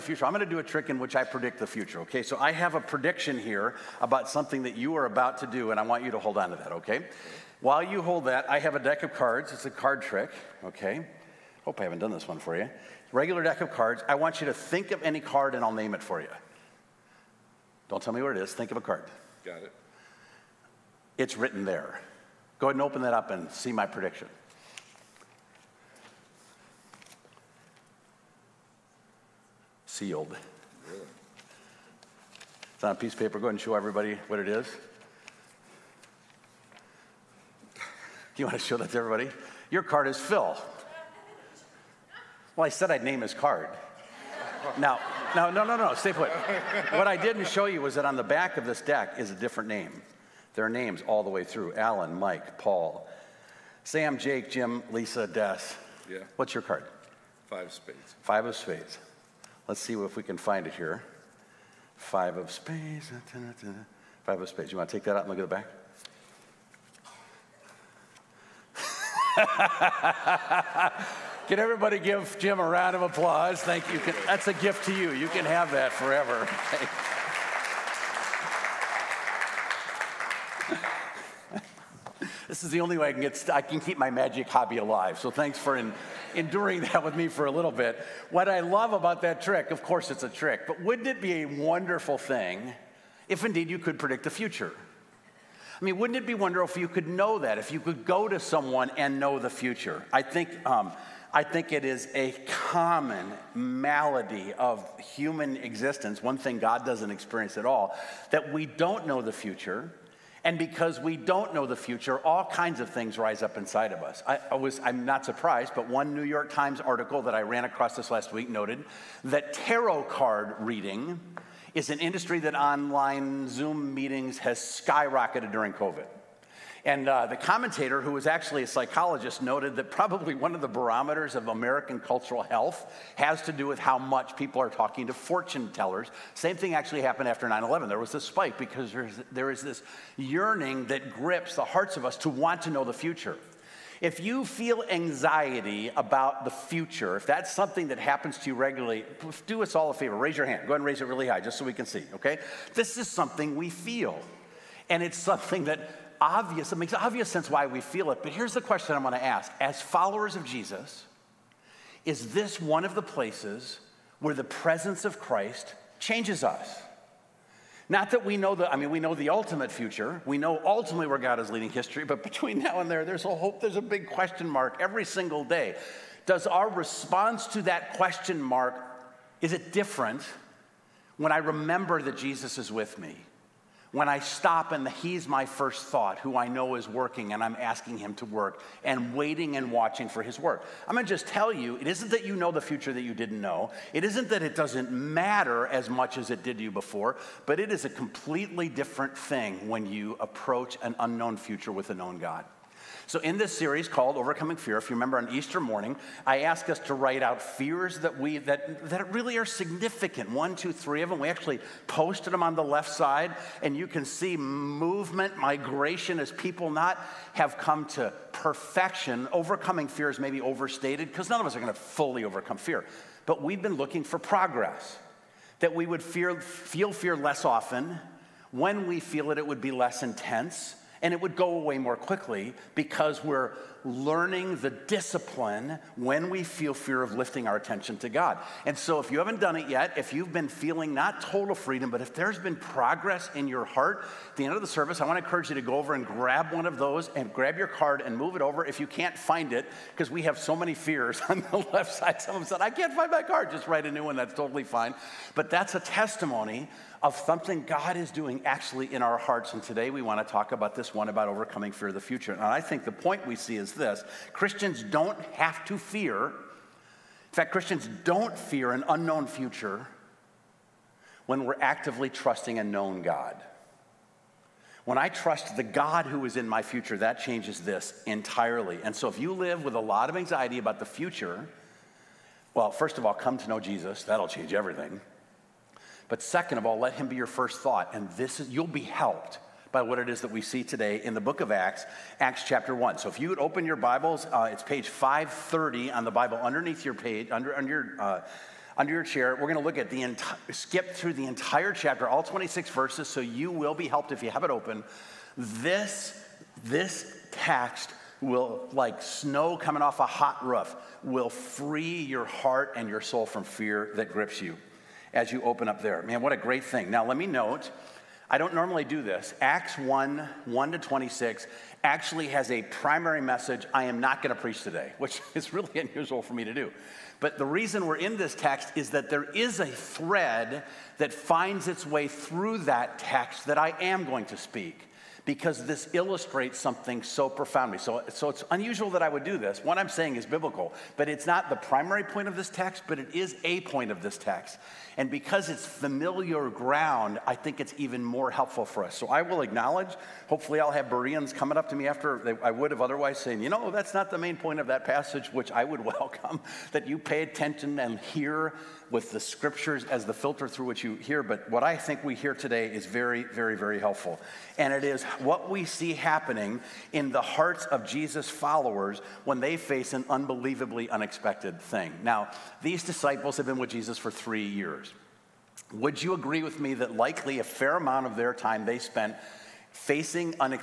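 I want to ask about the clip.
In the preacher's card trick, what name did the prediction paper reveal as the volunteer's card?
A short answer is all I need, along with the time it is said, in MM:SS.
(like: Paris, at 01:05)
Phil, at 00:40.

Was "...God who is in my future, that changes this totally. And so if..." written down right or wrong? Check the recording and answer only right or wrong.
wrong.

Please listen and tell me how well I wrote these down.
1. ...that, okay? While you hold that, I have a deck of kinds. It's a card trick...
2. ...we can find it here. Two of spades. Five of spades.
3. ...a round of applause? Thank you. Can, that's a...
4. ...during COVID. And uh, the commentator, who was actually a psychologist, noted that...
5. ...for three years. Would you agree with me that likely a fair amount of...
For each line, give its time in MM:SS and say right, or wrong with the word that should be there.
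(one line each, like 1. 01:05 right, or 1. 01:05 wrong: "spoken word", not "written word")
1. 00:06 wrong: "cards", not "kinds"
2. 01:00 wrong: "Five", not "Two"
3. 01:12 right
4. 02:05 right
5. 06:13 right.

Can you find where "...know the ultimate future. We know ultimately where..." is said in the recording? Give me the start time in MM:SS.
02:49.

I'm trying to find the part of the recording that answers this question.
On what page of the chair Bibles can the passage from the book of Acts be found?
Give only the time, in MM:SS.
04:54.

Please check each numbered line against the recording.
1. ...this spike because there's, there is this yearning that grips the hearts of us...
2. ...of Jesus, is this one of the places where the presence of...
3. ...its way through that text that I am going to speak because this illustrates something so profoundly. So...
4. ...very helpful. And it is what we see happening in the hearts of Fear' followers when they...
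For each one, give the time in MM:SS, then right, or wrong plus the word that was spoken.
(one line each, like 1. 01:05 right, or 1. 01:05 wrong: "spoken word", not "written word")
1. 02:18 right
2. 02:40 right
3. 05:31 right
4. 06:03 wrong: "Jesus", not "Fear".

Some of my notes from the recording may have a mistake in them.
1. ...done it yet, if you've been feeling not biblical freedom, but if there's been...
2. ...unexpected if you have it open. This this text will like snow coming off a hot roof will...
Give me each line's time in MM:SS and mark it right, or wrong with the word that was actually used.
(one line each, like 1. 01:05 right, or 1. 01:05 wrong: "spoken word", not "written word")
1. 03:59 wrong: "total", not "biblical"
2. 05:03 wrong: "helped", not "unexpected".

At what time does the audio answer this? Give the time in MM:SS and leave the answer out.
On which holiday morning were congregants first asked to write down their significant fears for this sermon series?
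03:25.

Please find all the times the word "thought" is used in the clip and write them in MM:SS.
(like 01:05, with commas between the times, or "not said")
03:05, 04:47.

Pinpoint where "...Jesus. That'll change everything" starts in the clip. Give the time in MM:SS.
04:43.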